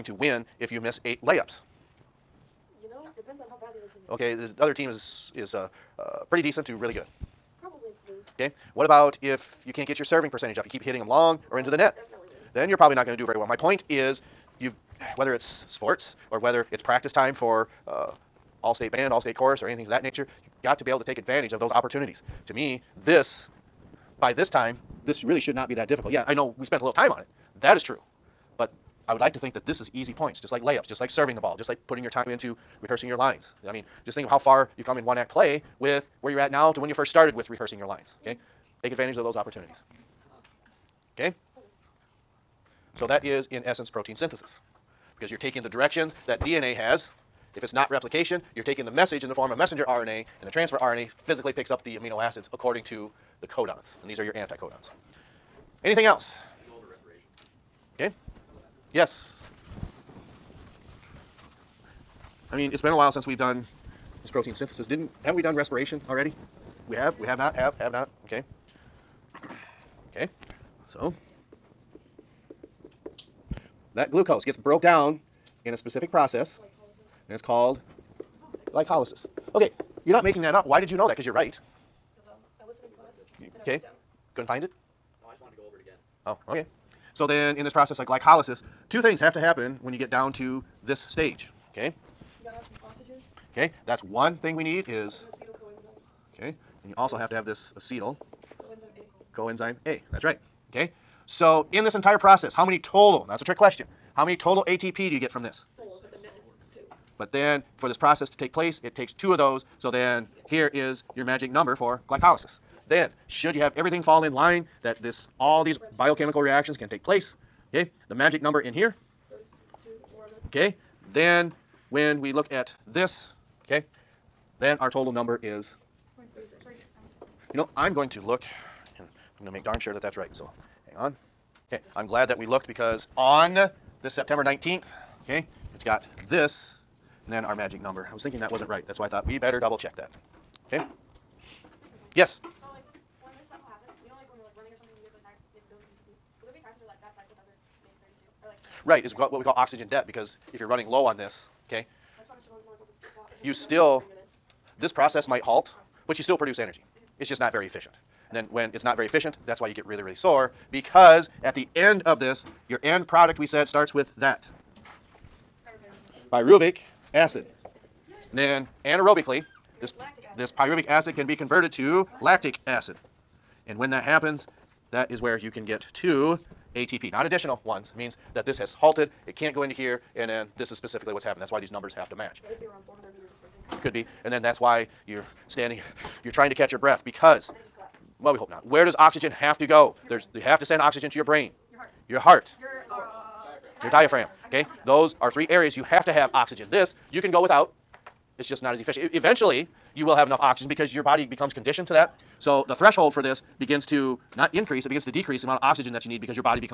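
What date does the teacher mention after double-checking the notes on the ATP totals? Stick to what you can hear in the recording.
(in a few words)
September 19th.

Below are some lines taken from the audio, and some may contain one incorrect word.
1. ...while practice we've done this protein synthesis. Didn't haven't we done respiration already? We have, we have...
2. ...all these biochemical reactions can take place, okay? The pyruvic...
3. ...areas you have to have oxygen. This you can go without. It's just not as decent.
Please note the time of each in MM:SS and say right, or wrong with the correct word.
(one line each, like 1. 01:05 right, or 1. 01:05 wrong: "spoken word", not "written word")
1. 01:02 wrong: "since", not "practice"
2. 01:55 wrong: "magic", not "pyruvic"
3. 03:15 wrong: "efficient", not "decent".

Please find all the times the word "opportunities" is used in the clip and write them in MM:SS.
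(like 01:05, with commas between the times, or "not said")
00:21, 00:39.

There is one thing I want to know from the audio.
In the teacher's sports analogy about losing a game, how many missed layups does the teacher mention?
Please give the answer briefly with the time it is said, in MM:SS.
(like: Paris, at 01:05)
8, at 00:01.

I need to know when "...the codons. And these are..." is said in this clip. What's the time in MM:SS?
00:53.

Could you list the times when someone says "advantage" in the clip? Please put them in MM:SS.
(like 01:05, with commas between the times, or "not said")
00:21, 00:38.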